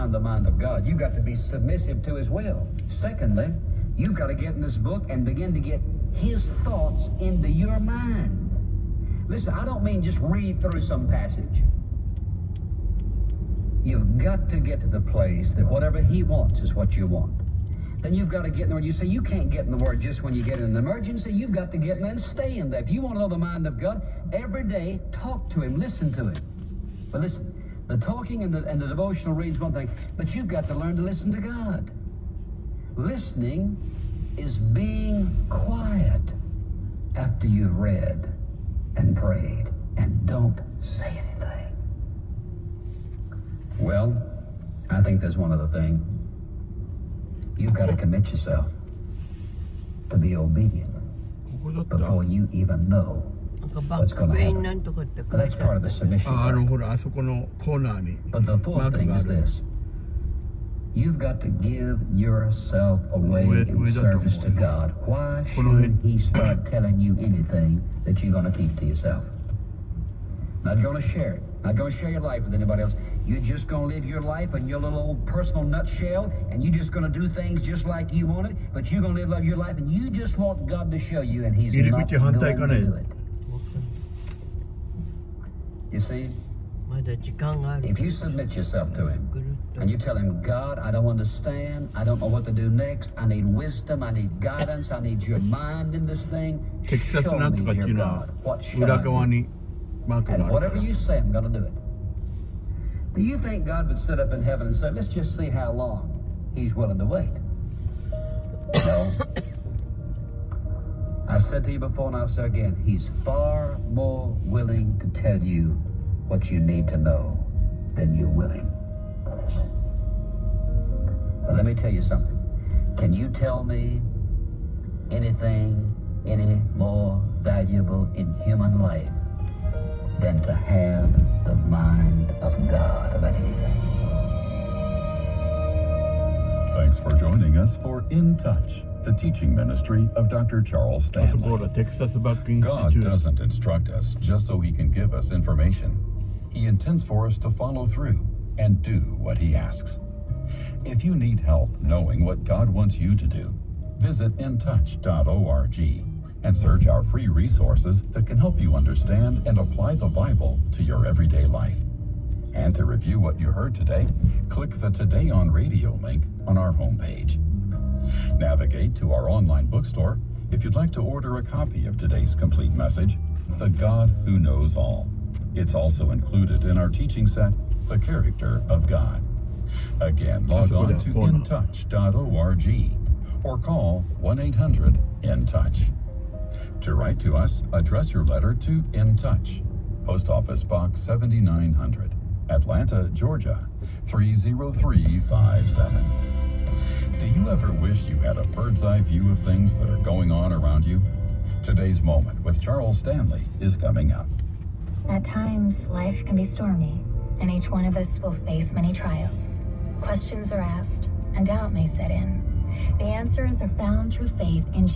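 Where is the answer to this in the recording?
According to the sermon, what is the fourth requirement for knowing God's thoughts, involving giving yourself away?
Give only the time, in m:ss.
1:03.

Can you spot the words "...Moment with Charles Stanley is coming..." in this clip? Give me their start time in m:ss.
3:22.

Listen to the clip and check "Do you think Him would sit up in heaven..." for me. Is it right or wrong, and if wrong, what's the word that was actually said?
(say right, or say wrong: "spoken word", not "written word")
wrong: "God", not "Him".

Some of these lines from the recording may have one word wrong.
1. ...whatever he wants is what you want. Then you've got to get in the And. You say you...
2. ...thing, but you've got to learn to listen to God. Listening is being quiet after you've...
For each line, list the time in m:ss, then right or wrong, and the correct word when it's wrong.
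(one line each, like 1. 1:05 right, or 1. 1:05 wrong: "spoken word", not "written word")
1. 0:15 wrong: "Word", not "And"
2. 0:29 right.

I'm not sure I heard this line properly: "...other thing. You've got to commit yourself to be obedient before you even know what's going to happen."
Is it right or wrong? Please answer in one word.
right.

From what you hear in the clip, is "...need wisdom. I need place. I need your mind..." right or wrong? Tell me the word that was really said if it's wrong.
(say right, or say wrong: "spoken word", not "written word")
wrong: "guidance", not "place".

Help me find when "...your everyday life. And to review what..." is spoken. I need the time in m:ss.
2:40.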